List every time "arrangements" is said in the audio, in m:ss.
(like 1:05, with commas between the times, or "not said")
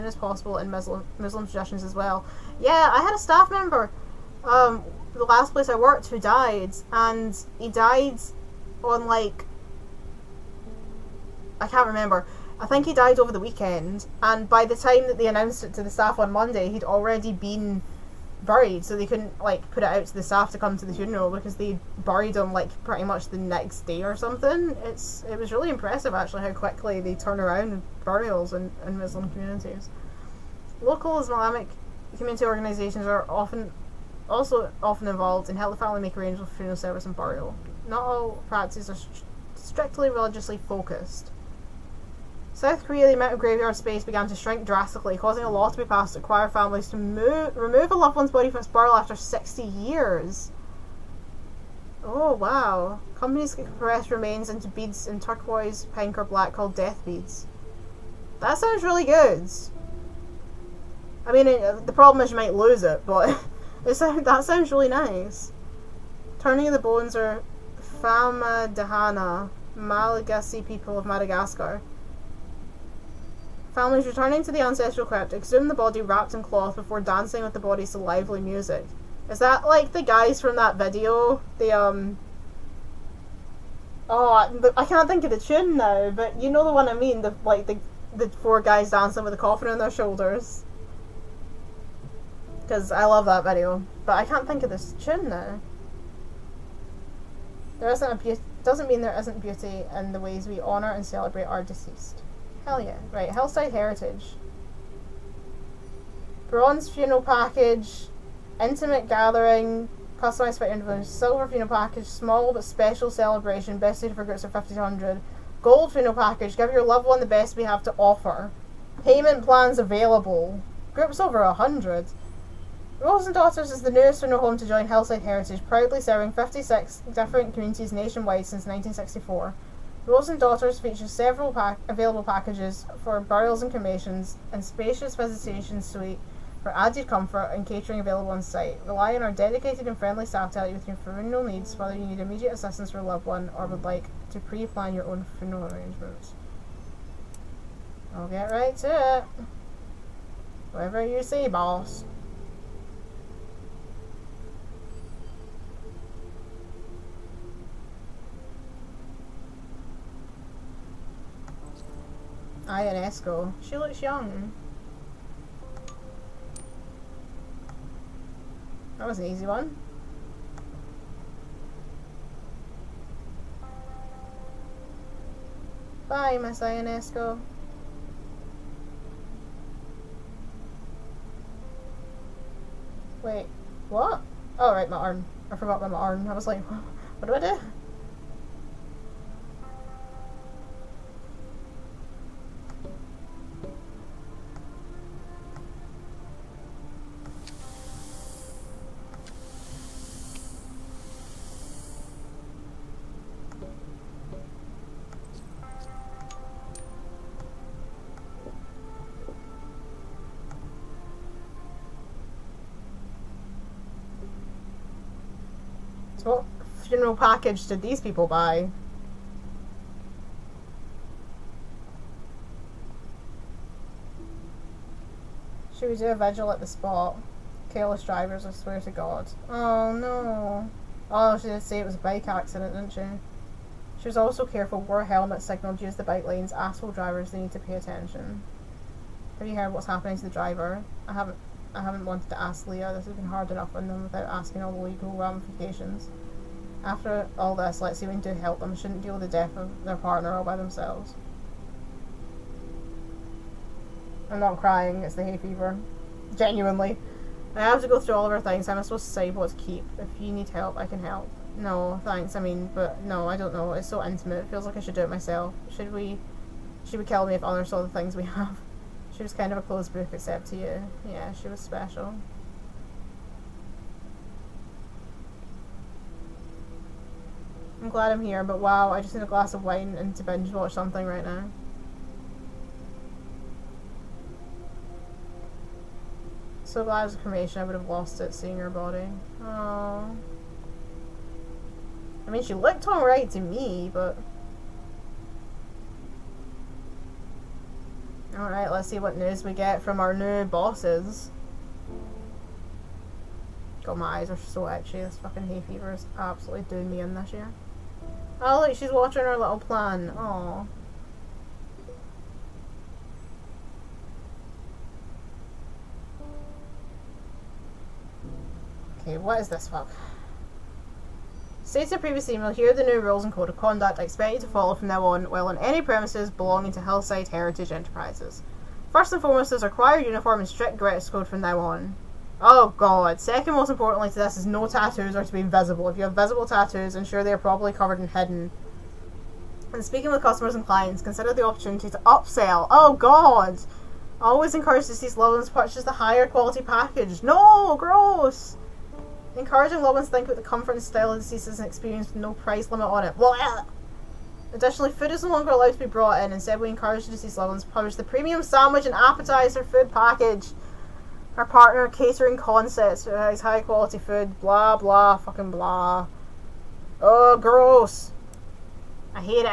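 0:36, 2:25.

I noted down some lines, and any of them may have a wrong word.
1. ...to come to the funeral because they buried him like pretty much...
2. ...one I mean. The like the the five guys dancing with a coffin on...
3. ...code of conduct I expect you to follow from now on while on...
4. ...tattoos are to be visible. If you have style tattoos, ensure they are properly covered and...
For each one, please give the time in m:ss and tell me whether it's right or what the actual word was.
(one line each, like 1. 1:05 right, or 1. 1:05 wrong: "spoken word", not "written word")
1. 0:20 right
2. 1:26 wrong: "four", not "five"
3. 5:23 right
4. 5:34 wrong: "visible", not "style".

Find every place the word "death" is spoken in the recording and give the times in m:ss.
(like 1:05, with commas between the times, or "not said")
0:56, 4:09.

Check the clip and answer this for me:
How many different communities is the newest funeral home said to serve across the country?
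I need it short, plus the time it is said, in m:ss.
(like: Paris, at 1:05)
56, at 2:06.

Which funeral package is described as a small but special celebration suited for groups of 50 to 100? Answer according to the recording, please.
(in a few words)
Silver.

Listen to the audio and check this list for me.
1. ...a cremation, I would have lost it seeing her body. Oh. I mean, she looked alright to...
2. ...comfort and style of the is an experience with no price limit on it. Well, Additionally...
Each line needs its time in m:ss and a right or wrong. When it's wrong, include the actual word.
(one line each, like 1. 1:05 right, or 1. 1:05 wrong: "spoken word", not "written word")
1. 4:47 right
2. 5:50 right.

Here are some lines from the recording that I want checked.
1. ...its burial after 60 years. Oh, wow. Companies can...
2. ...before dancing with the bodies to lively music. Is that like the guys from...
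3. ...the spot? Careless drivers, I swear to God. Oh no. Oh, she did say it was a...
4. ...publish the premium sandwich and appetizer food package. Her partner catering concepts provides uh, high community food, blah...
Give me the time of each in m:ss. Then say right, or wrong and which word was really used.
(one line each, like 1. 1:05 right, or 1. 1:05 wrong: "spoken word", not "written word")
1. 0:48 right
2. 1:16 right
3. 3:46 right
4. 5:57 wrong: "quality", not "community".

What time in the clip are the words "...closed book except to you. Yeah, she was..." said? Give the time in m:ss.
4:29.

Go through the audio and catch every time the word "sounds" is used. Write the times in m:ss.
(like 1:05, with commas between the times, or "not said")
0:58, 1:04.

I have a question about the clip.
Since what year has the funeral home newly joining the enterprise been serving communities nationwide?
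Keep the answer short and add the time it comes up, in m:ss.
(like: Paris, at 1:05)
1964, at 2:08.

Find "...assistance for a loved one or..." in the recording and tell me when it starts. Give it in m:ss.
2:22.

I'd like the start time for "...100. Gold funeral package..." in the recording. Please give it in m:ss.
1:54.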